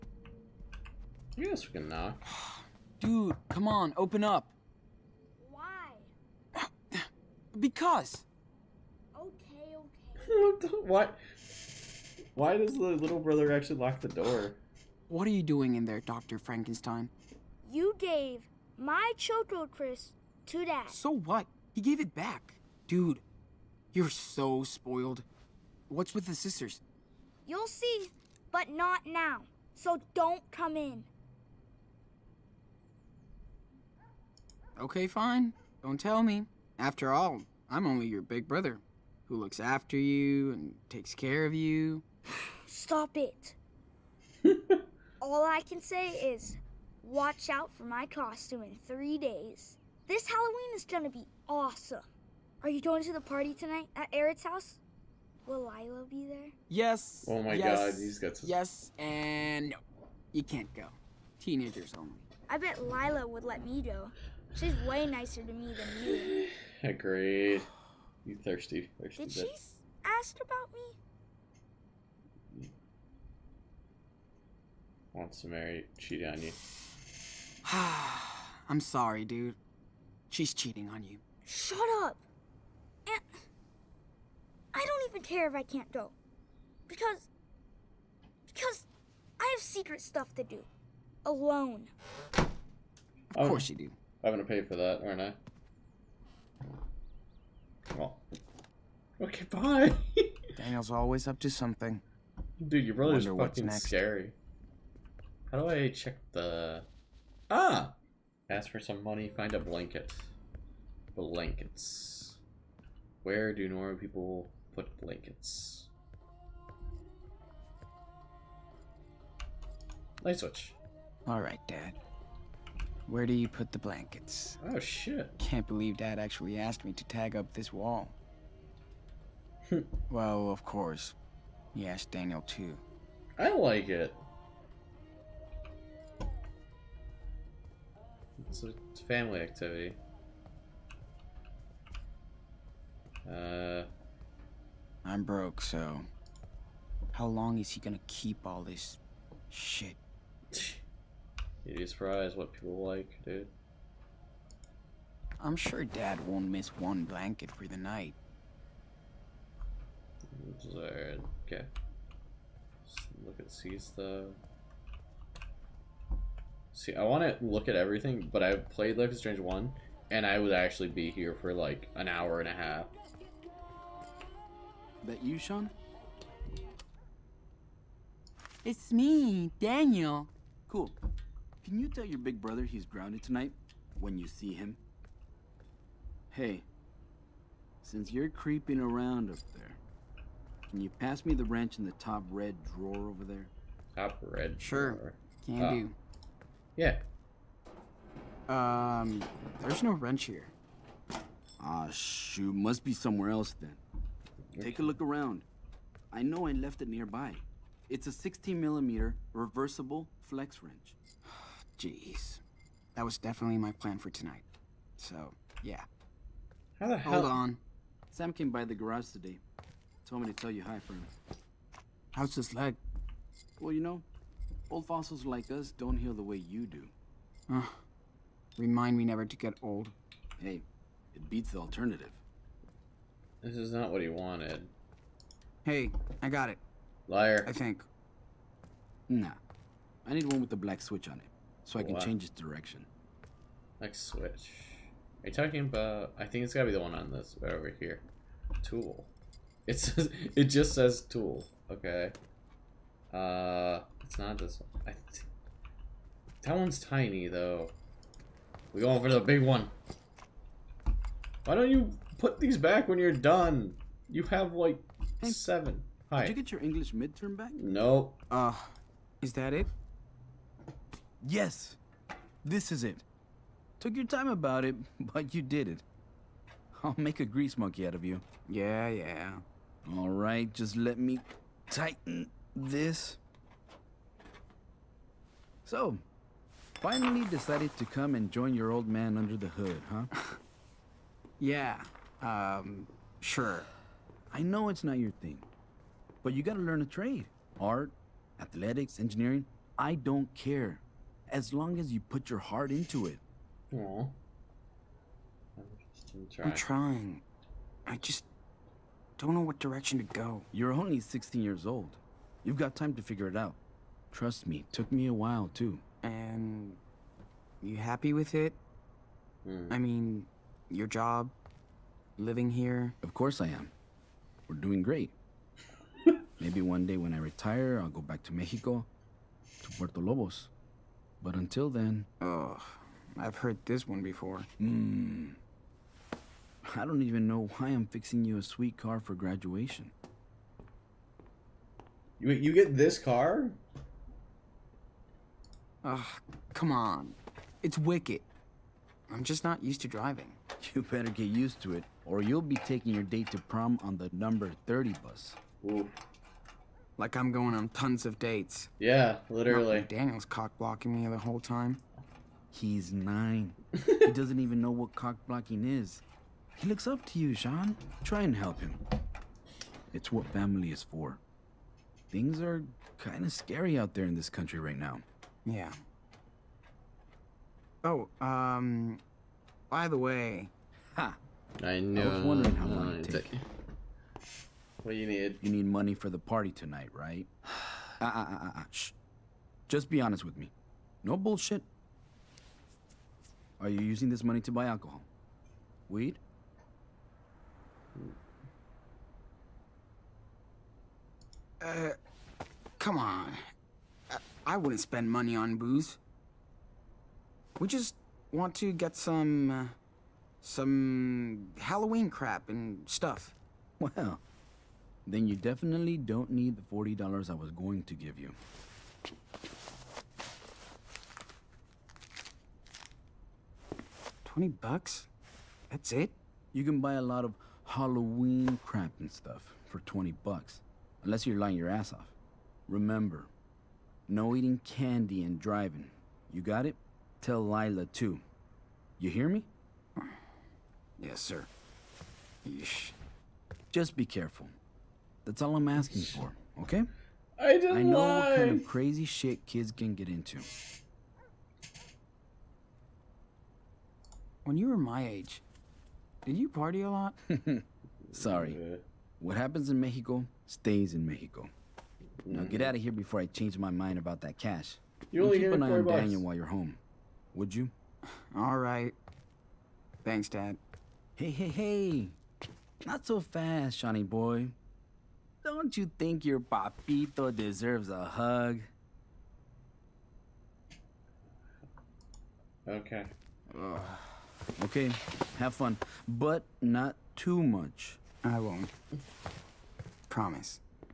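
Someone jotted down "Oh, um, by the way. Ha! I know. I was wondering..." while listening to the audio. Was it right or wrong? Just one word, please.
right.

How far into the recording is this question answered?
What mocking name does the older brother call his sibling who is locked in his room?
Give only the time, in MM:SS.
00:16.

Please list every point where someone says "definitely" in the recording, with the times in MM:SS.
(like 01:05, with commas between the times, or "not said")
03:33, 06:55.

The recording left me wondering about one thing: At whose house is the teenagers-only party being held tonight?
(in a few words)
Eric's.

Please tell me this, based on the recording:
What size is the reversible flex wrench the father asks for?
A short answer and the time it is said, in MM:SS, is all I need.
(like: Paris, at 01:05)
16 millimeter, at 03:28.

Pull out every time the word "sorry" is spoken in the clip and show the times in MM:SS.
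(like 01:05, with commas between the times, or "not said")
01:18, 07:38.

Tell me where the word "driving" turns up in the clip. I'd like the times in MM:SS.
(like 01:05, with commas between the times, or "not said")
05:49, 07:15.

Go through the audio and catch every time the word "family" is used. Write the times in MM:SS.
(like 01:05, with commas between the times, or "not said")
02:19, 06:10.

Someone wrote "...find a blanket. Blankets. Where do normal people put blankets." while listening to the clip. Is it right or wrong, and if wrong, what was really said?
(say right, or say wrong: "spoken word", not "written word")
right.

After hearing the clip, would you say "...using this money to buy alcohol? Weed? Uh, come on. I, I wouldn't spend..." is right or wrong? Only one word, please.
right.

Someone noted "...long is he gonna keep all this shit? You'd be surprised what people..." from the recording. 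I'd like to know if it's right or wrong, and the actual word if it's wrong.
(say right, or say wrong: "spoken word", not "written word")
right.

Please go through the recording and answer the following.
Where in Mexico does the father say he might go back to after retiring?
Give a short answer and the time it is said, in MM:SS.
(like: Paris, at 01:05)
Puerto Lobos, at 05:29.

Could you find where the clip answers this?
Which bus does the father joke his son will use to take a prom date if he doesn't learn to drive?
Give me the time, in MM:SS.
05:54.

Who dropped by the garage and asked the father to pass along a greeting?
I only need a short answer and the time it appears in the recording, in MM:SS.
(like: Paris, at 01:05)
Sam, at 03:38.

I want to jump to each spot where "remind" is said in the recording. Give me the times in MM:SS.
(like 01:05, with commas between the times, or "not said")
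03:48.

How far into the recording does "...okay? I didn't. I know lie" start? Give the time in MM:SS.
07:26.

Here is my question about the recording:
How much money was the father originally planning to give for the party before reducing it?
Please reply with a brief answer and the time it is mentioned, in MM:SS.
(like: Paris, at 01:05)
$40, at 06:56.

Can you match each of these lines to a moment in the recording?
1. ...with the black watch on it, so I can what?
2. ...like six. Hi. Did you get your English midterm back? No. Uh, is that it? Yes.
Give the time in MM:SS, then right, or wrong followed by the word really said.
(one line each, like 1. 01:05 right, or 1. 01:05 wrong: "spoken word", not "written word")
1. 04:00 wrong: "switch", not "watch"
2. 04:24 wrong: "seven", not "six".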